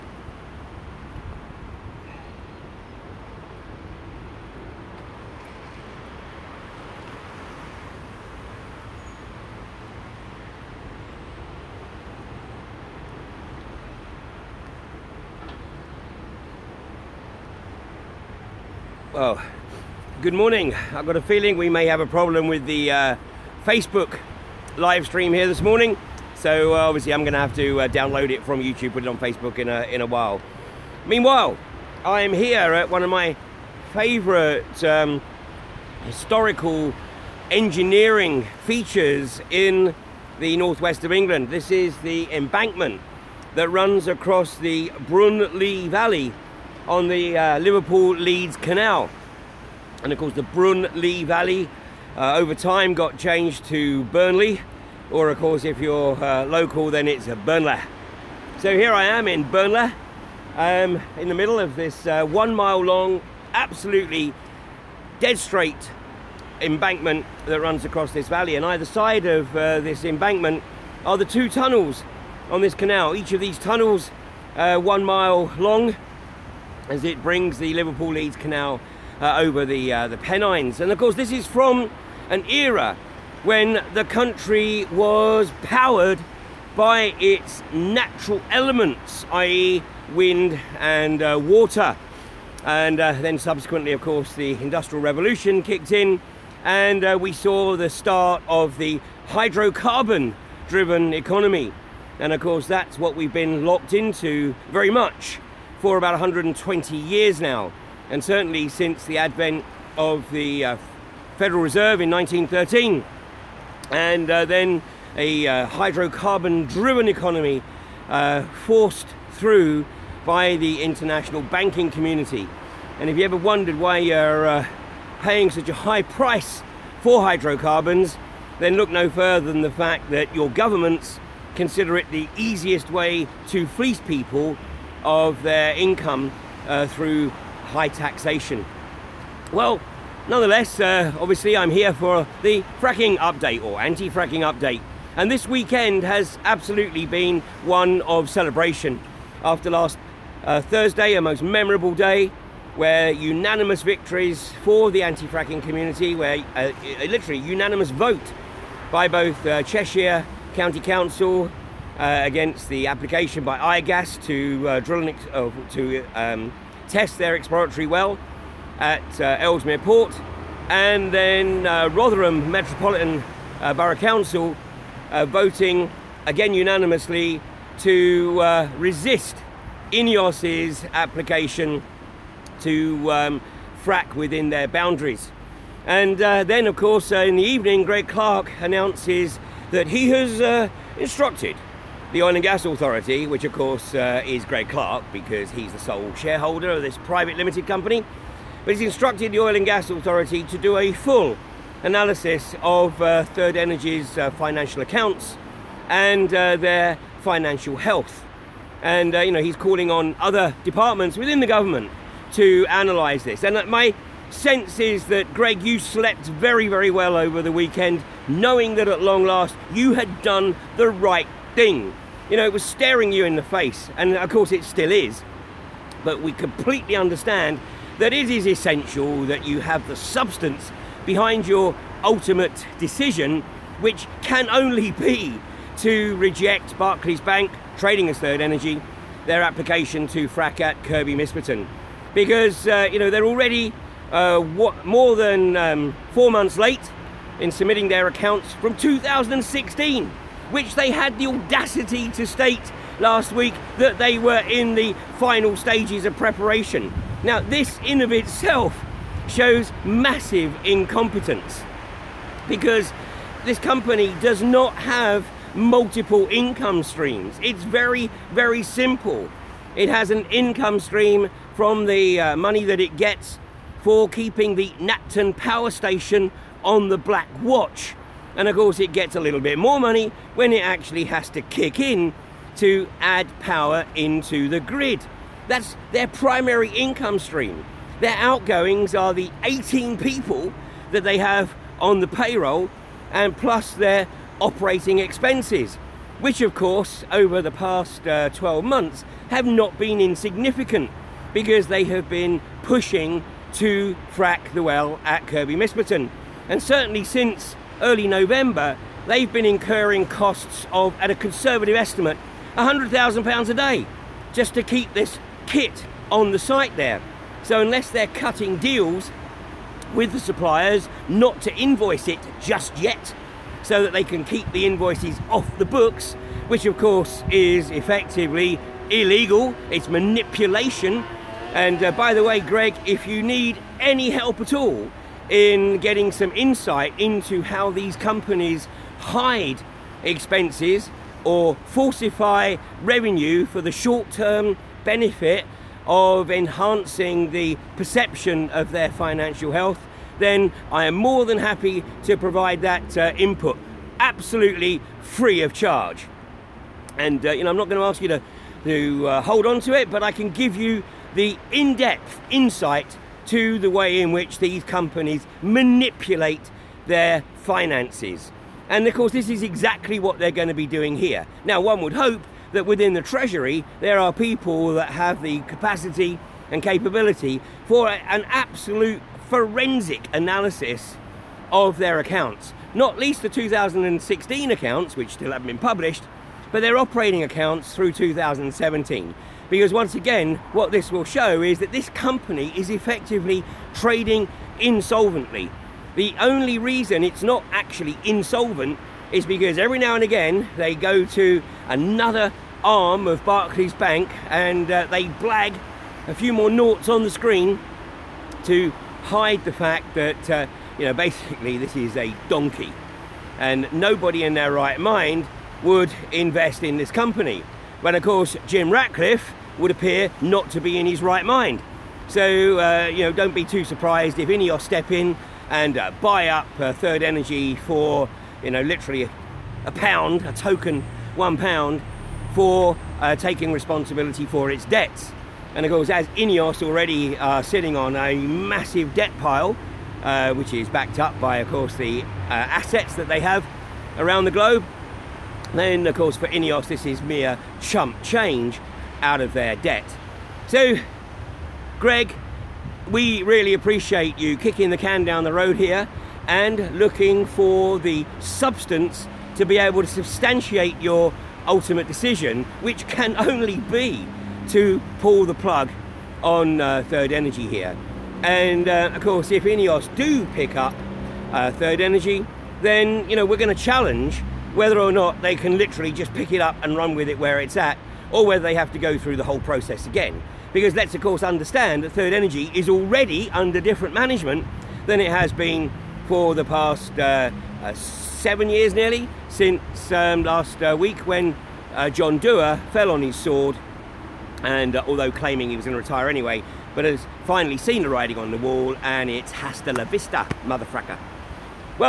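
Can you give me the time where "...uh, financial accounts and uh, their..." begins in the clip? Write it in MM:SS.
03:24.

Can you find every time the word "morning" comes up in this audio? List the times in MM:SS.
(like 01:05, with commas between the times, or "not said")
00:20, 00:25.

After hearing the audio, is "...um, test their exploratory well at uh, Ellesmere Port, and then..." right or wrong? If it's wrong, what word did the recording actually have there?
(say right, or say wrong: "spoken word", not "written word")
right.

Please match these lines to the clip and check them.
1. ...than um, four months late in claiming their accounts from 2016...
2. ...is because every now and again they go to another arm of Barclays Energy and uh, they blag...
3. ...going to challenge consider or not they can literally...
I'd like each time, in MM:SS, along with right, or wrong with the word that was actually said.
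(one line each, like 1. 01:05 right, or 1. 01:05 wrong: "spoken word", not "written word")
1. 04:05 wrong: "submitting", not "claiming"
2. 06:39 wrong: "Bank", not "Energy"
3. 07:53 wrong: "whether", not "consider".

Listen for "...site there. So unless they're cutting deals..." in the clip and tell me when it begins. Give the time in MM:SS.
05:16.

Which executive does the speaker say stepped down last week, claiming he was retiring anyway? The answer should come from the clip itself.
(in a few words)
John Dewar.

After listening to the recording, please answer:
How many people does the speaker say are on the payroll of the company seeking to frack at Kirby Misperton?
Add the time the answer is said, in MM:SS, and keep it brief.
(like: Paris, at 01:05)
18, at 04:49.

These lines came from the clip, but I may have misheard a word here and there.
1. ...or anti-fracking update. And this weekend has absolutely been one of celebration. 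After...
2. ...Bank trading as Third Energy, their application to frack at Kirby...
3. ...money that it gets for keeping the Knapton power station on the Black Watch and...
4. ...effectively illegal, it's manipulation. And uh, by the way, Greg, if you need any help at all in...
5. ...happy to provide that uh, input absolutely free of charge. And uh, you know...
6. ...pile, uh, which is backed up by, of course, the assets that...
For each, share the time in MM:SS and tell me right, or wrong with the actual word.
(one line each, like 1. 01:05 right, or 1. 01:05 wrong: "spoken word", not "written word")
1. 02:23 right
2. 03:57 right
3. 04:32 right
4. 05:27 right
5. 05:51 right
6. 07:19 right.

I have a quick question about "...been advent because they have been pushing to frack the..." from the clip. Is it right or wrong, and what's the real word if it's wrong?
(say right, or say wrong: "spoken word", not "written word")
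wrong: "insignificant", not "advent".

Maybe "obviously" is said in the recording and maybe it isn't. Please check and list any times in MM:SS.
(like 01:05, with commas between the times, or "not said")
00:26, 02:21.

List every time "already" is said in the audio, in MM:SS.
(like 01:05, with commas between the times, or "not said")
04:03, 07:16, 08:02.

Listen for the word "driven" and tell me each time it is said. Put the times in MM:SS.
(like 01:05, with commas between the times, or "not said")
01:40, 01:55.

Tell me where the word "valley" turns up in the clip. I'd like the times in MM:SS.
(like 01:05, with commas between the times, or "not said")
00:45, 00:51, 01:08.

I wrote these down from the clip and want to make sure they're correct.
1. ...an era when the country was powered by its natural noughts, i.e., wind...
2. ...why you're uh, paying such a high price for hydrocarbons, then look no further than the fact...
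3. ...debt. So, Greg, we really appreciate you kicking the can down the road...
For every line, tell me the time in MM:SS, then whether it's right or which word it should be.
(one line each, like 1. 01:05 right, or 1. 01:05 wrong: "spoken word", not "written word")
1. 01:22 wrong: "elements", not "noughts"
2. 02:03 right
3. 07:29 right.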